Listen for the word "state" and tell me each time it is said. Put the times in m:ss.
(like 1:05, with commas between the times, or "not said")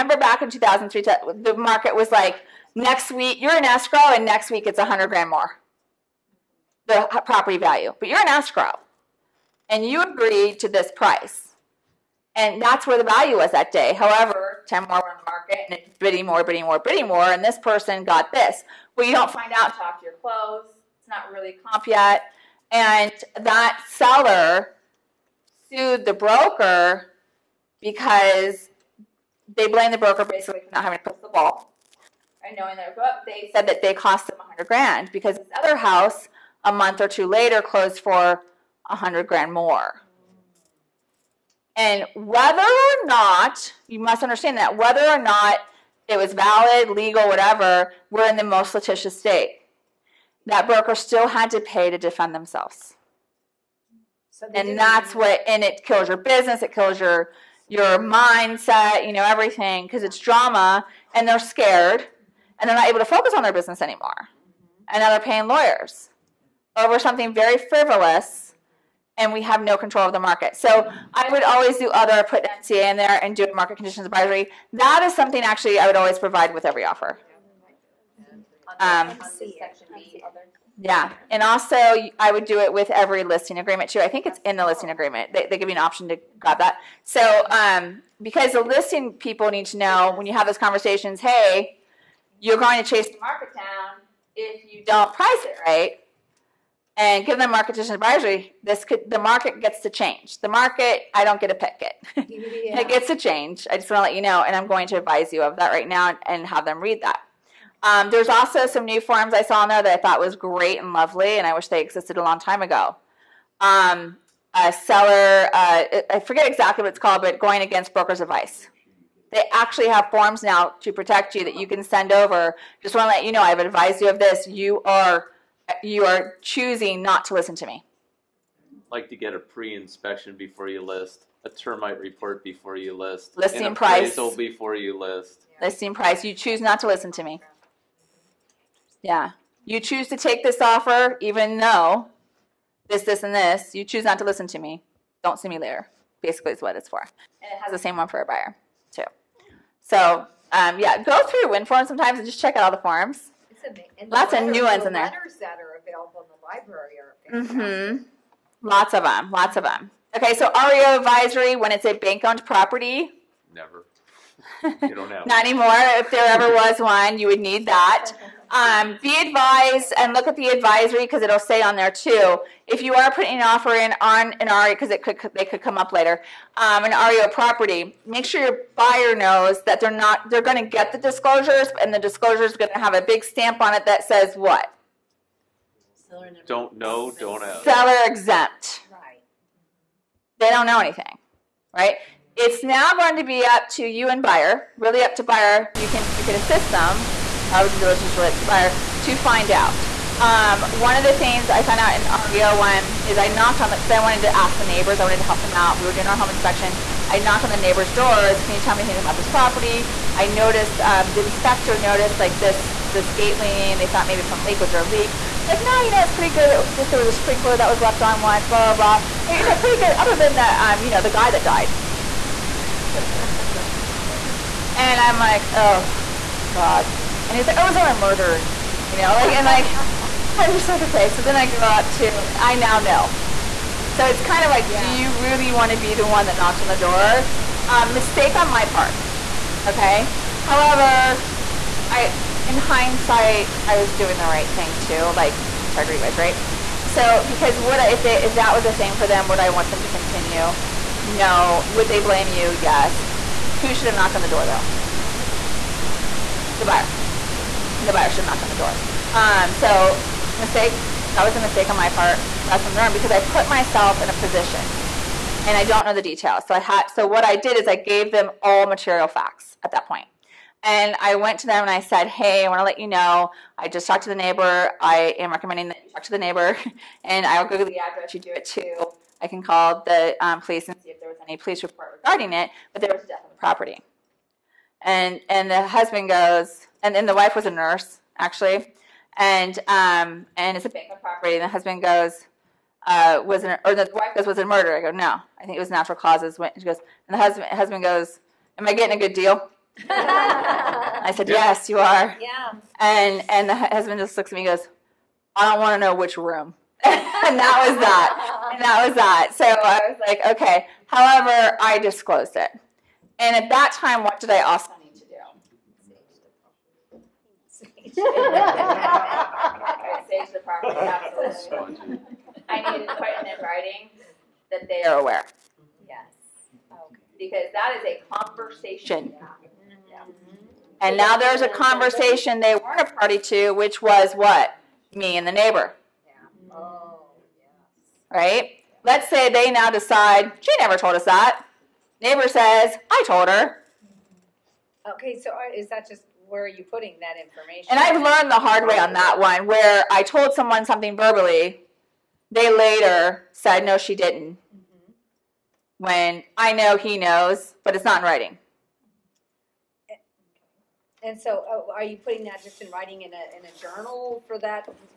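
0:49.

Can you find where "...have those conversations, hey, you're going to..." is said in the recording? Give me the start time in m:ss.
1:30.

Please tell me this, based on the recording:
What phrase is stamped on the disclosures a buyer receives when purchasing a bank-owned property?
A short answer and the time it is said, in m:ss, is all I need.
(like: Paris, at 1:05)
Seller exempt, at 3:07.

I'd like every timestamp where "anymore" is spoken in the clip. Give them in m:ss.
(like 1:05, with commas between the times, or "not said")
1:03, 2:45.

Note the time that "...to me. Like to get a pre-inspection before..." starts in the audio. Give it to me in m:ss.
2:07.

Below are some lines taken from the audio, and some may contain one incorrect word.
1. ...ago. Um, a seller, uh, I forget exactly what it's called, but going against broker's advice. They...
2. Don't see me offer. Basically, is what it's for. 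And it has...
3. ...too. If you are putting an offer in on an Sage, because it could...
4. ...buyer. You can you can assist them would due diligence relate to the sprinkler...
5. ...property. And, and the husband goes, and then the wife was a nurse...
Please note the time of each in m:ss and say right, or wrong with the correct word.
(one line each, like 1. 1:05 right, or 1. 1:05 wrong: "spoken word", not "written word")
1. 1:52 right
2. 2:25 wrong: "later", not "offer"
3. 2:51 wrong: "REO", not "Sage"
4. 3:15 wrong: "buyer", not "sprinkler"
5. 4:43 right.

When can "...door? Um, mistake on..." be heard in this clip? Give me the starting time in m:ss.
3:56.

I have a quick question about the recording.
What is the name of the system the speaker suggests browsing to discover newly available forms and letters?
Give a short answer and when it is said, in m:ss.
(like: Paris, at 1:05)
WINForms, at 2:31.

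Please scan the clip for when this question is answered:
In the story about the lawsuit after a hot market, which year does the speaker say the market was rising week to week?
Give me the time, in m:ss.
0:00.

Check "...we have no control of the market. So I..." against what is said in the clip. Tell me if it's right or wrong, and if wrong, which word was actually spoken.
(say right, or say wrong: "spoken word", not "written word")
right.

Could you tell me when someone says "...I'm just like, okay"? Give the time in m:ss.
3:50.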